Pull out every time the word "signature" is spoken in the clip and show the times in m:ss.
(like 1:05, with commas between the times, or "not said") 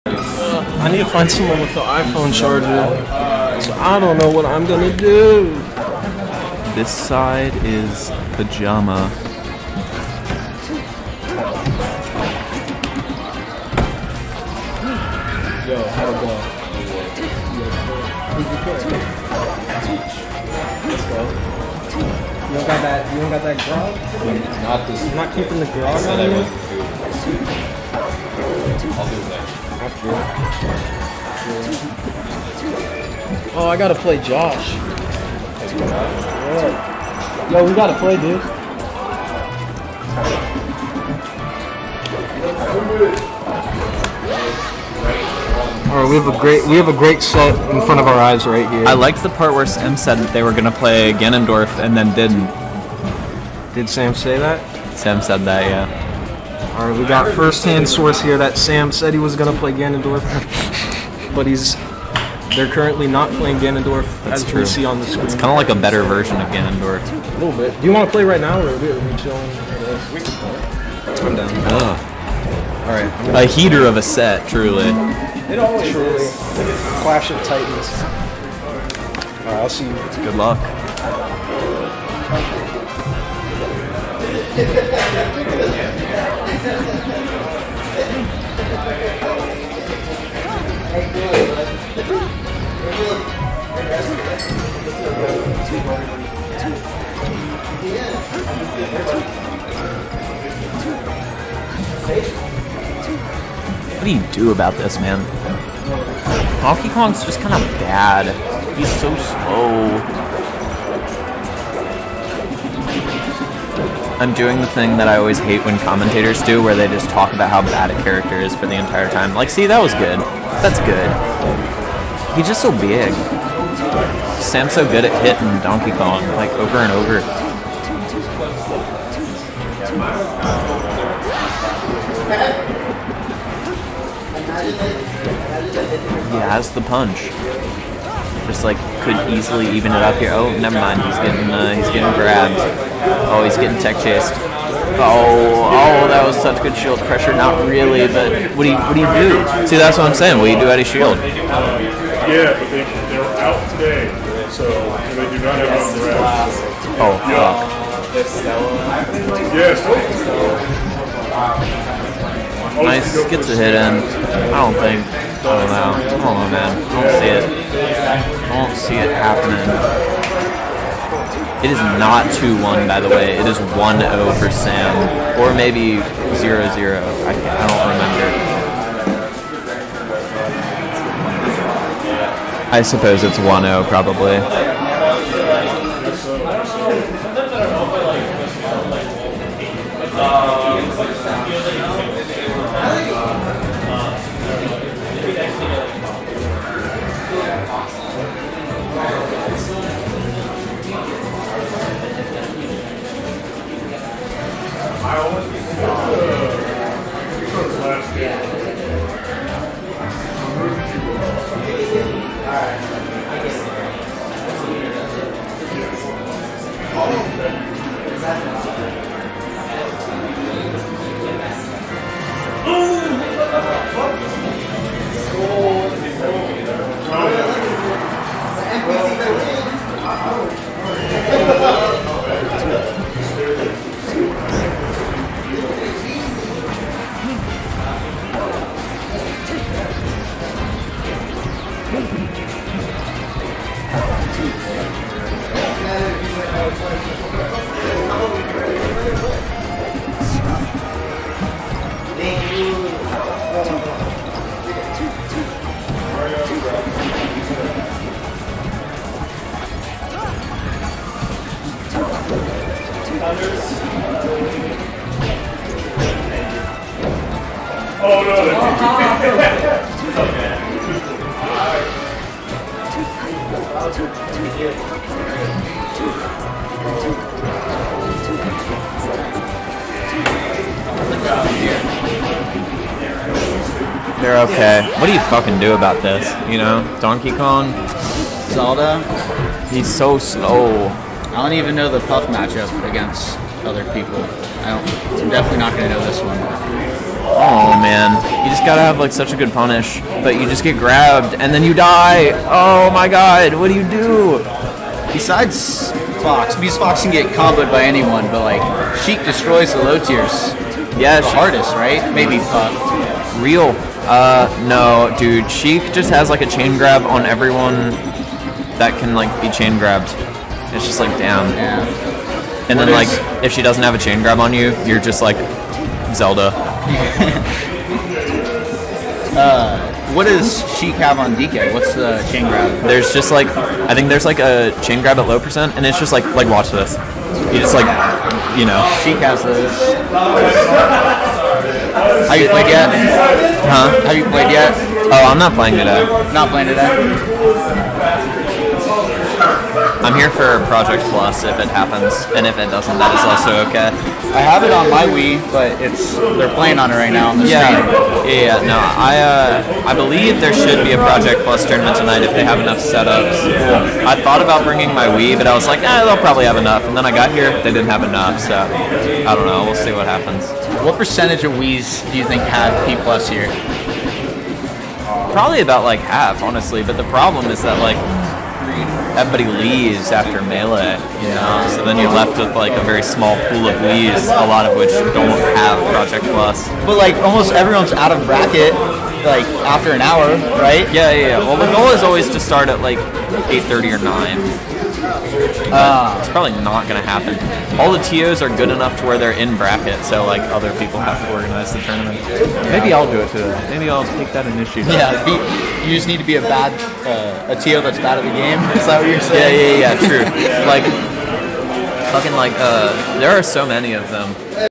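not said.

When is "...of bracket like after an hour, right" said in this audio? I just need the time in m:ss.
6:28.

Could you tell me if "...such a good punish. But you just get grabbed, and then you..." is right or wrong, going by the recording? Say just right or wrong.
right.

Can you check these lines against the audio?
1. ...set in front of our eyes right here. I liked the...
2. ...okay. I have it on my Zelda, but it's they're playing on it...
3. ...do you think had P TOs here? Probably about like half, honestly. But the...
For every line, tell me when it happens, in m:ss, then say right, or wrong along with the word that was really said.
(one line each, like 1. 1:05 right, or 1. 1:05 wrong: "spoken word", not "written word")
1. 0:47 right
2. 5:53 wrong: "Wii", not "Zelda"
3. 6:12 wrong: "Plus", not "TOs".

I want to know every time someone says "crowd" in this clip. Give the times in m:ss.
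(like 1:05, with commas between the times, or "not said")
not said.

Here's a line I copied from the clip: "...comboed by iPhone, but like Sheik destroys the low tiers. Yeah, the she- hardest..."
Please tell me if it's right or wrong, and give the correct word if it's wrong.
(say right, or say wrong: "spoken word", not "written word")
wrong: "anyone", not "iPhone".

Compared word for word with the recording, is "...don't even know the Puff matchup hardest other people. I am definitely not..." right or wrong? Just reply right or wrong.
wrong.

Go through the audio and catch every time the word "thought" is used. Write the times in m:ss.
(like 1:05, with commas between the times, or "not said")
6:04.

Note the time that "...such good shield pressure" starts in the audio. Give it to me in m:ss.
2:26.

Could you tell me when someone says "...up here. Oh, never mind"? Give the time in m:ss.
2:20.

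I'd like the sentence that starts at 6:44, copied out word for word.
Yeah, be, you just need to be a bad uh, a TO that's bad at the game.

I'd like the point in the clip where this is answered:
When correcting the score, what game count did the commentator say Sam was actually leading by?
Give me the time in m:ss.
2:53.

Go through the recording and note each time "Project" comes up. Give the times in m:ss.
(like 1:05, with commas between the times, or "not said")
5:50, 6:00, 6:25.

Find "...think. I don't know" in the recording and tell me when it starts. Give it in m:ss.
2:44.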